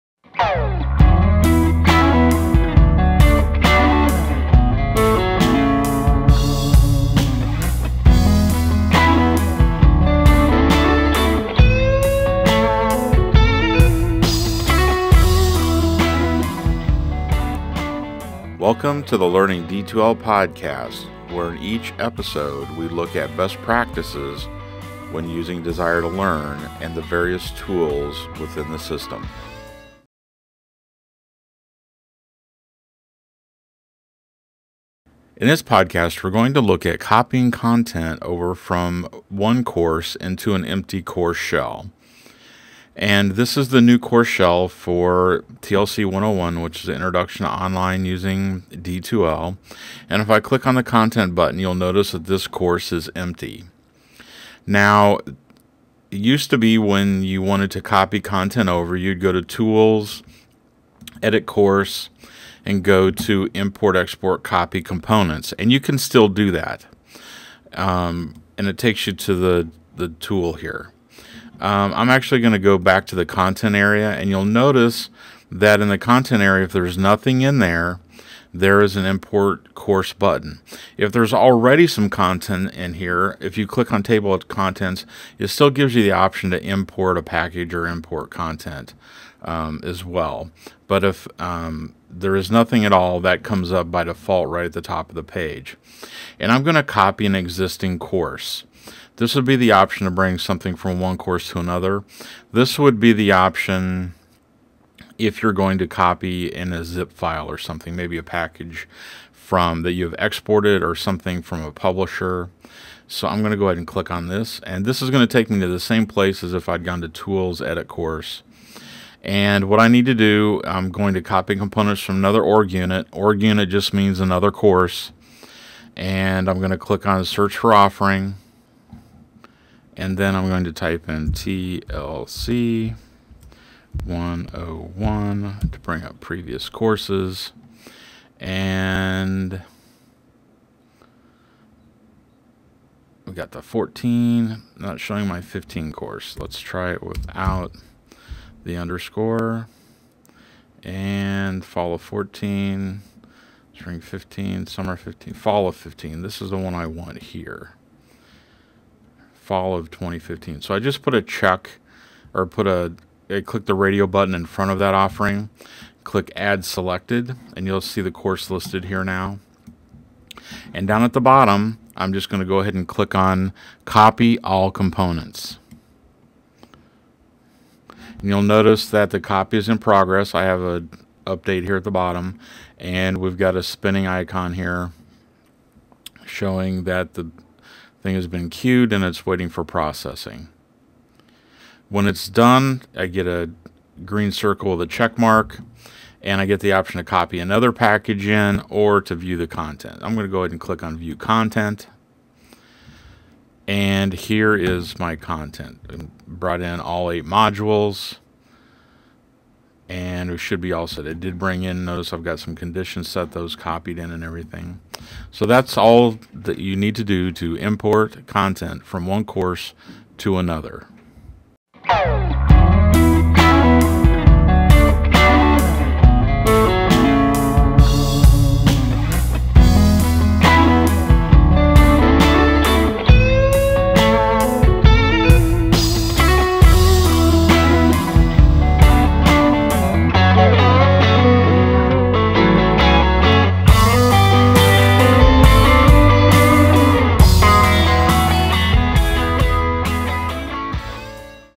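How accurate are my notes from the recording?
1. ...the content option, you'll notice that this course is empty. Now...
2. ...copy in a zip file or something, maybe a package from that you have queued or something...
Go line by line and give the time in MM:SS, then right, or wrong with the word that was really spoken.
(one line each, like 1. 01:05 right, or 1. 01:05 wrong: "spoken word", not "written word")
1. 00:50 wrong: "button", not "option"
2. 01:45 wrong: "exported", not "queued".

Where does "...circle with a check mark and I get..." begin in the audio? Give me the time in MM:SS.
03:14.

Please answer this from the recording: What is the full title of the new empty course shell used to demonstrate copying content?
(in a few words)
Introduction to online using D2L.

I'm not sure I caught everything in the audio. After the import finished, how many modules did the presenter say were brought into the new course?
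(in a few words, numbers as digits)
8.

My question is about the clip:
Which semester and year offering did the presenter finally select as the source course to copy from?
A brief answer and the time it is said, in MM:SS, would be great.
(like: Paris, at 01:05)
Fall of 2015, at 02:39.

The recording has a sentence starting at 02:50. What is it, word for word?
And down at the bottom, I'm just going to go ahead and click on copy all components.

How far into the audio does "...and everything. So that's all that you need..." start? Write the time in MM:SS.
03:34.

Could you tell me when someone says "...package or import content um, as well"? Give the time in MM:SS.
01:27.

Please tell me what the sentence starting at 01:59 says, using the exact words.
And what I need to do, I'm going to copy components from another org unit.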